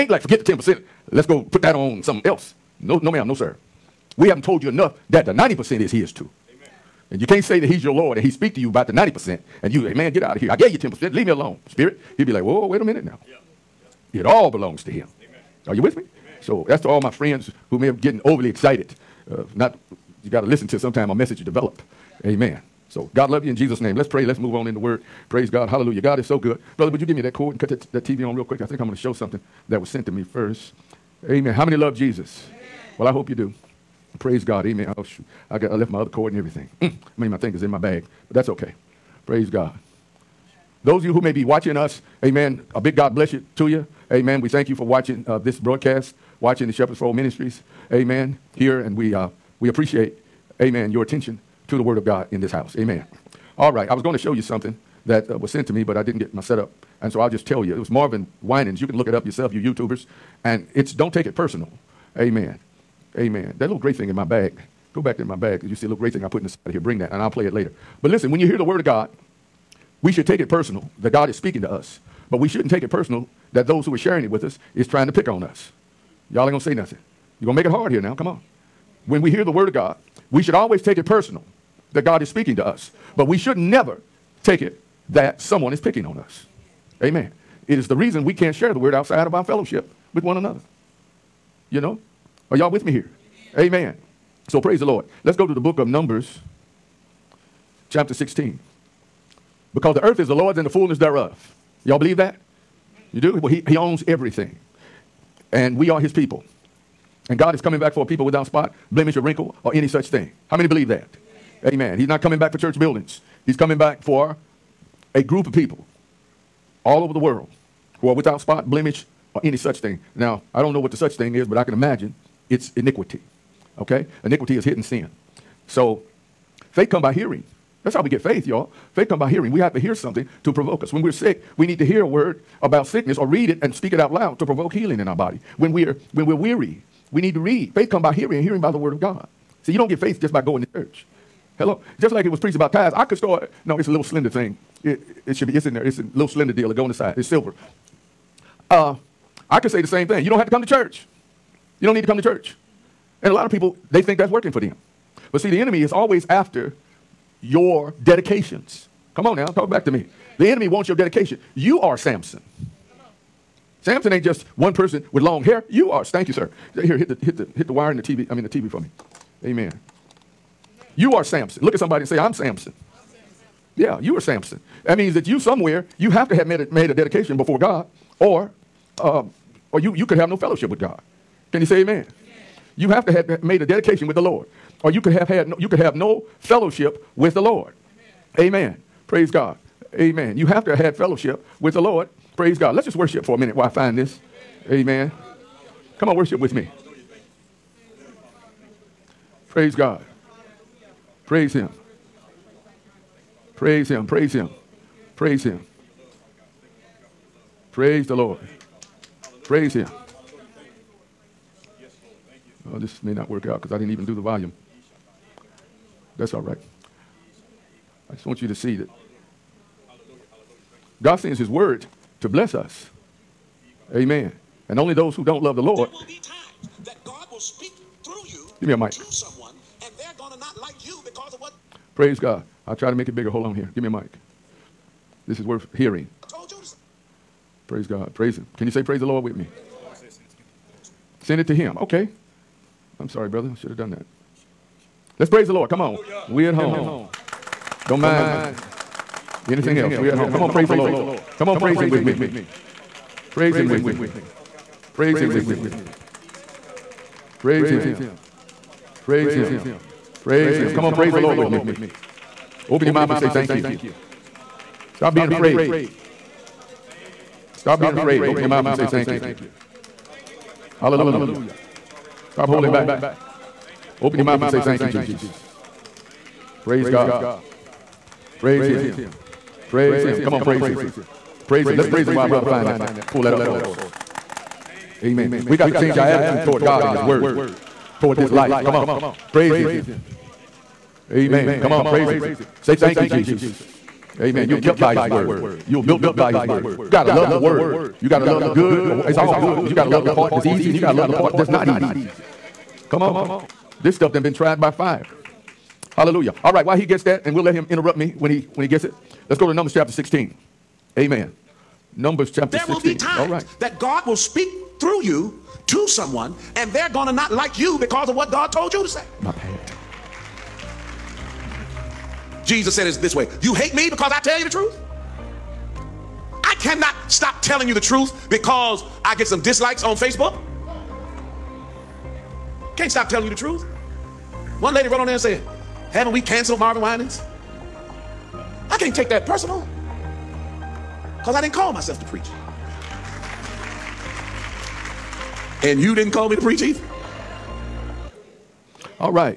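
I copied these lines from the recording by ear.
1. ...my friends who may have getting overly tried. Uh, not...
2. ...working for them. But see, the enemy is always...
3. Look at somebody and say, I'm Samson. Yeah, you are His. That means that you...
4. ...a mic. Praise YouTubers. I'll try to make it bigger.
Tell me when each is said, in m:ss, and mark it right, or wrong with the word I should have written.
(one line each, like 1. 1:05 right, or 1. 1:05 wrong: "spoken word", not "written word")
1. 0:17 wrong: "excited", not "tried"
2. 2:34 right
3. 2:51 wrong: "Samson", not "His"
4. 3:48 wrong: "God", not "YouTubers".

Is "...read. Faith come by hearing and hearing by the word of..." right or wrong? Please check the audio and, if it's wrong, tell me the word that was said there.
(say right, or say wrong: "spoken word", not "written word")
right.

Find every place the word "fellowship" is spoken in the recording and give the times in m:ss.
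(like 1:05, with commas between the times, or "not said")
1:29, 3:00, 3:06, 3:10.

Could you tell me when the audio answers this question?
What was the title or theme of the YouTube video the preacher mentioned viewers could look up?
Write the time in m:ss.
1:00.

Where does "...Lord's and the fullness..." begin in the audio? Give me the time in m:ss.
1:40.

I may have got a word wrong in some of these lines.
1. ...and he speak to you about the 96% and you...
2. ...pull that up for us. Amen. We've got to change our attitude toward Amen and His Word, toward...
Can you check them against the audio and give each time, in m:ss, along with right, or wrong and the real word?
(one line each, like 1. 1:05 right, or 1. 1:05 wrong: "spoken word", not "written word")
1. 0:08 wrong: "90", not "96"
2. 4:43 wrong: "God", not "Amen".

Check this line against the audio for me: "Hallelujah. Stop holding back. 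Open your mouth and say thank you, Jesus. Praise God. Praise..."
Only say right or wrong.
right.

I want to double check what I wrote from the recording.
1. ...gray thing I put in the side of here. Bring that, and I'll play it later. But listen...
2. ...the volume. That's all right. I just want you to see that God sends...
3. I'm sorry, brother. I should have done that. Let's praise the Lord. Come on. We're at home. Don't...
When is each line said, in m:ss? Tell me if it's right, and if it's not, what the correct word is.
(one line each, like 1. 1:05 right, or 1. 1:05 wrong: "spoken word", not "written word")
1. 1:05 right
2. 3:34 right
3. 4:02 right.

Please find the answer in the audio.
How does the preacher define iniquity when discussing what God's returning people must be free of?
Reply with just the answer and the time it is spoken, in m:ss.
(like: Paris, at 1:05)
Hidden sin, at 2:04.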